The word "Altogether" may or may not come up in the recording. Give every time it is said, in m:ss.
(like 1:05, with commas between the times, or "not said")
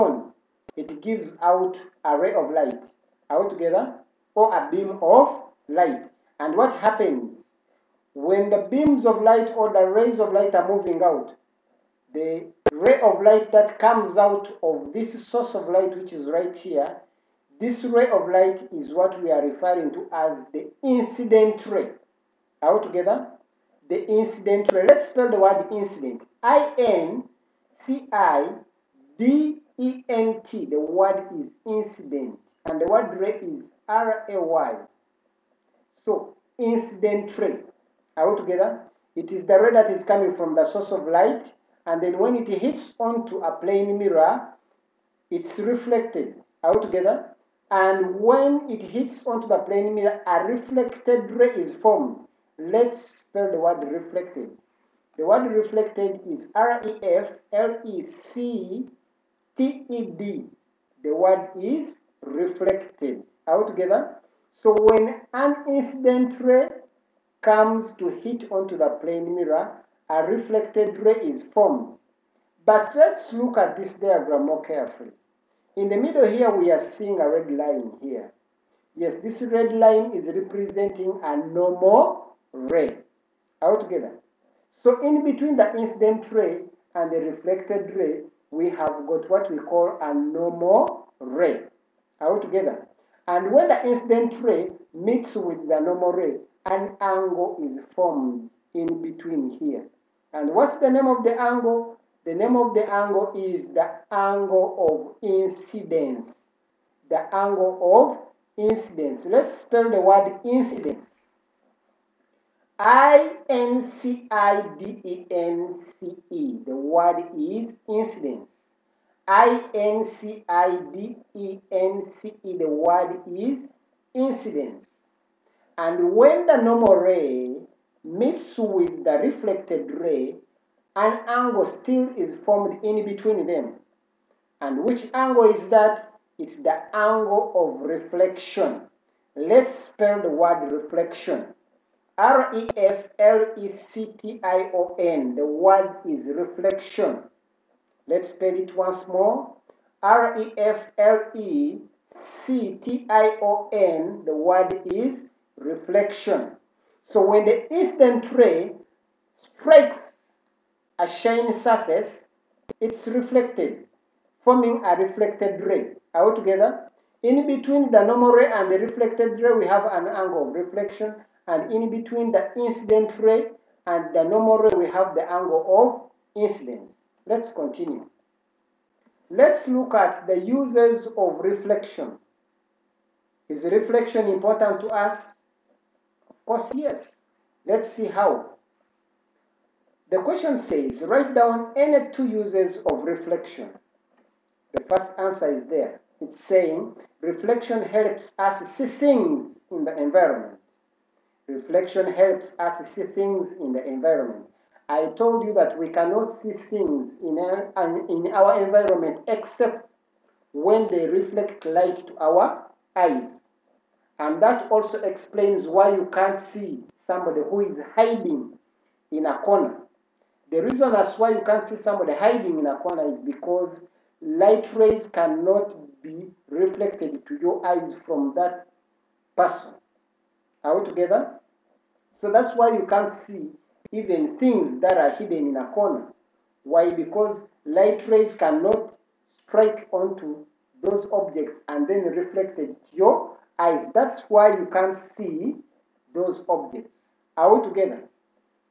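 1:23, 1:32.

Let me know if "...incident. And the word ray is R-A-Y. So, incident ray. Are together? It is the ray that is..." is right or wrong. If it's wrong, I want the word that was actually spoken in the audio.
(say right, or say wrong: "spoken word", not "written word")
right.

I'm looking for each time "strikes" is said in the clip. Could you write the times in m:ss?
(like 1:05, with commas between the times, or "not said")
2:39, 3:59.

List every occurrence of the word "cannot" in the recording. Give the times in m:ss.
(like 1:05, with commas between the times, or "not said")
3:25, 3:45, 3:58.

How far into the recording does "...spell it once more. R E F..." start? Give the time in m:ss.
2:28.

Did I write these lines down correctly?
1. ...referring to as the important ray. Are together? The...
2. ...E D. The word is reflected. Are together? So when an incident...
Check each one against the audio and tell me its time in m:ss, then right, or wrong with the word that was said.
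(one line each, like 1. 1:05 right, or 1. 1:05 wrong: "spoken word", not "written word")
1. 0:19 wrong: "incident", not "important"
2. 0:59 right.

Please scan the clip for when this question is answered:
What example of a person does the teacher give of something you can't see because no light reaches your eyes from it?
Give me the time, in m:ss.
3:41.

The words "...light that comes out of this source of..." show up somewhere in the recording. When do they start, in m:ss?
0:13.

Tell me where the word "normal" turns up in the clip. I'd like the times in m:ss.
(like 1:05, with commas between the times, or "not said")
1:21, 1:30, 1:35, 2:06, 2:48, 2:54.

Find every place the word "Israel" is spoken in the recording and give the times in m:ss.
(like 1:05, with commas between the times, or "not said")
not said.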